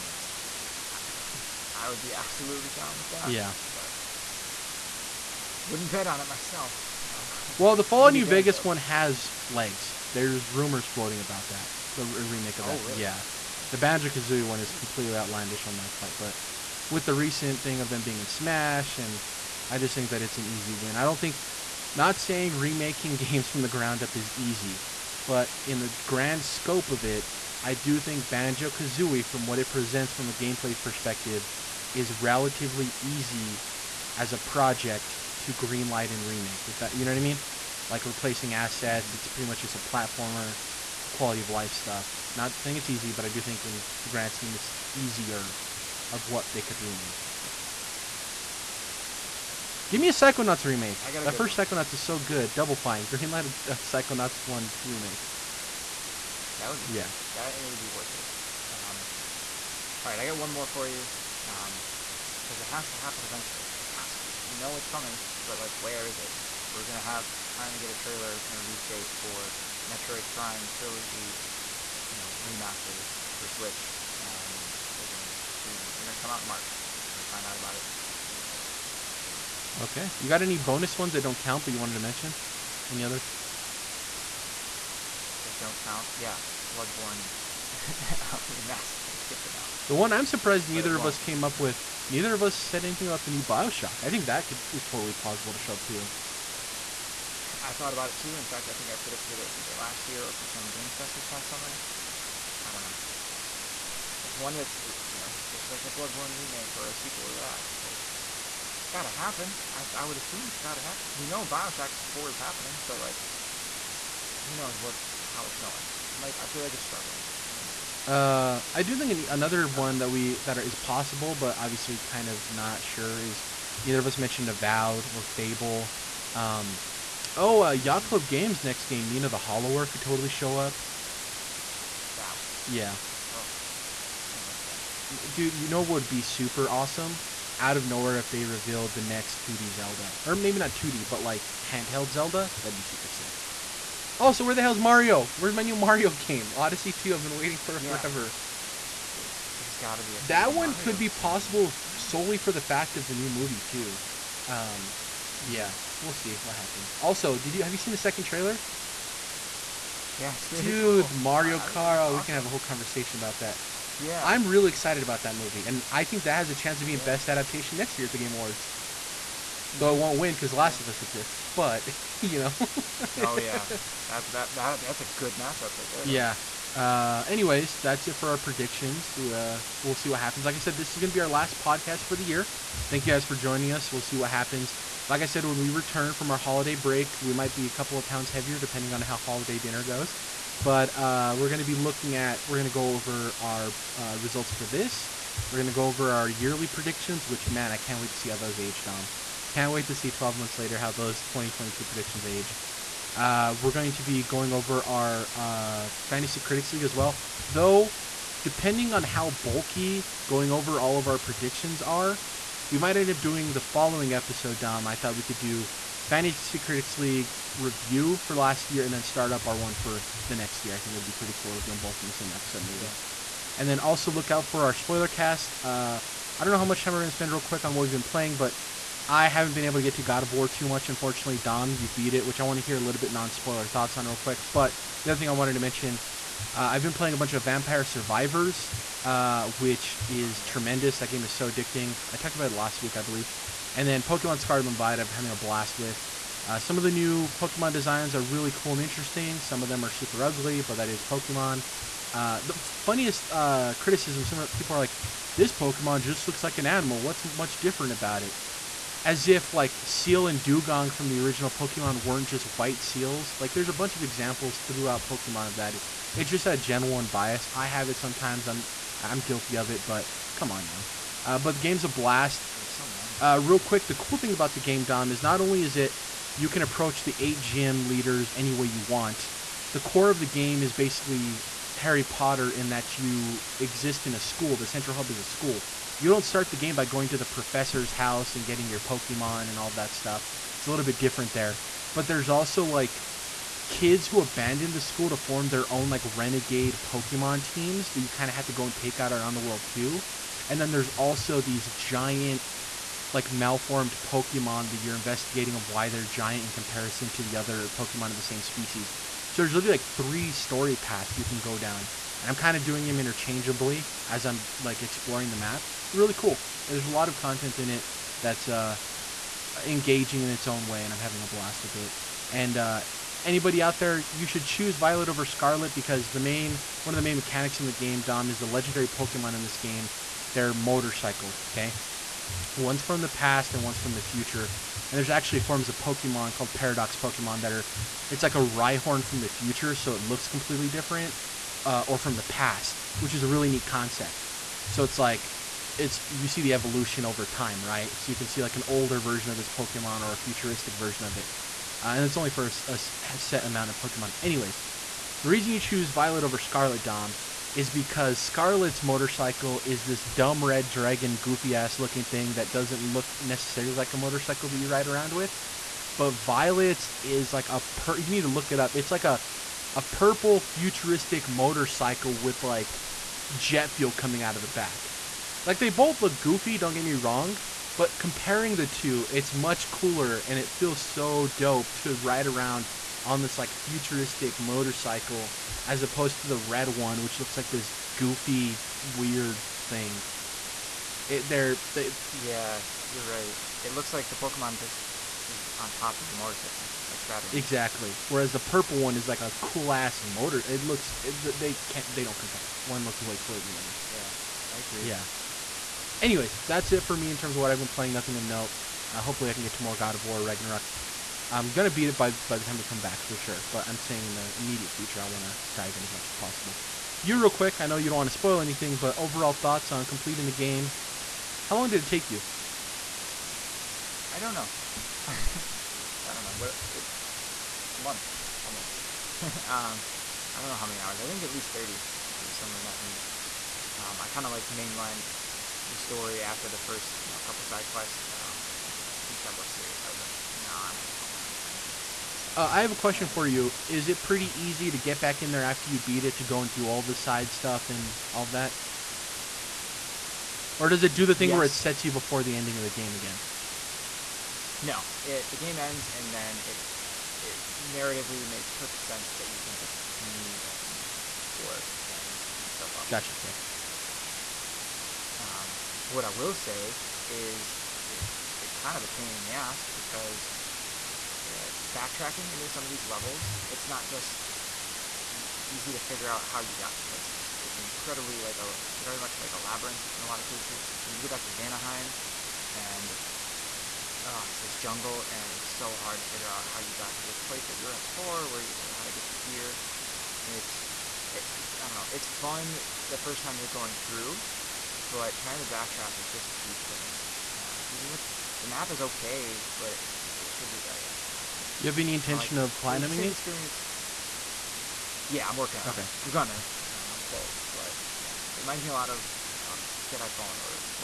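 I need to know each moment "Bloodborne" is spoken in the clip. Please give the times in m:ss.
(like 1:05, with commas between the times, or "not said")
1:26, 1:45.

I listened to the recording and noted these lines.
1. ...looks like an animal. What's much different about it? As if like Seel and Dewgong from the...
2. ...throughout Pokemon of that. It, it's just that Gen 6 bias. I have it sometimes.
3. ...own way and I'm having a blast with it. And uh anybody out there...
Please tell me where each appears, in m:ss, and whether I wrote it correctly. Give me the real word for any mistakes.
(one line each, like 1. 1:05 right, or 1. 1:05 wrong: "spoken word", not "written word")
1. 4:16 right
2. 4:24 wrong: "1", not "6"
3. 5:20 right.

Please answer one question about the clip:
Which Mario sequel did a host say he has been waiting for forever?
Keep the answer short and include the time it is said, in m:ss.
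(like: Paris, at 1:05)
Odyssey 2, at 2:26.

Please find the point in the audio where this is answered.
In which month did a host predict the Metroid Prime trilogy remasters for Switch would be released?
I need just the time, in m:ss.
1:16.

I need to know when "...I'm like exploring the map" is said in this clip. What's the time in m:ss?
5:14.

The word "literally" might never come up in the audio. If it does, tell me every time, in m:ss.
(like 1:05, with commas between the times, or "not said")
5:09.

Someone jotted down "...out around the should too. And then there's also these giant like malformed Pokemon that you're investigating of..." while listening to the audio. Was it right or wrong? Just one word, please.
wrong.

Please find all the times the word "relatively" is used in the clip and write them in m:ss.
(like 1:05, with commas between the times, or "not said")
0:32.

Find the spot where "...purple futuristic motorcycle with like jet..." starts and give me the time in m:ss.
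6:09.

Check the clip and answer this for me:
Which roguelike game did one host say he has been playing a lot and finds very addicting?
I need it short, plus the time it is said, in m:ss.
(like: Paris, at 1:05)
Vampire Survivors, at 3:57.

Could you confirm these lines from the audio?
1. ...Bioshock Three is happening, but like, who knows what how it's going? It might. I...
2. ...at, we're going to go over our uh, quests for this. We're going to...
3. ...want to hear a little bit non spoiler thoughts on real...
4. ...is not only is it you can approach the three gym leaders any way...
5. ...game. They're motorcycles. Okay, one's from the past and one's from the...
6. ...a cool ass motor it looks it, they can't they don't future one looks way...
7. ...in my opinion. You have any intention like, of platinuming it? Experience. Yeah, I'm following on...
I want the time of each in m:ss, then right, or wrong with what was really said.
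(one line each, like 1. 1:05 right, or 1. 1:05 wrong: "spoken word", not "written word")
1. 1:51 wrong: "Four", not "Three"
2. 3:12 wrong: "results", not "quests"
3. 3:52 right
4. 4:35 wrong: "eight", not "three"
5. 5:29 right
6. 6:39 wrong: "compare", not "future"
7. 8:21 wrong: "working", not "following".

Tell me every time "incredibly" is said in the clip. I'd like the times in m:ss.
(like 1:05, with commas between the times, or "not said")
7:57.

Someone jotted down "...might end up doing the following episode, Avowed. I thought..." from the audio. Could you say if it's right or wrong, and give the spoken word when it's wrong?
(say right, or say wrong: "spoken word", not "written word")
wrong: "Dom", not "Avowed".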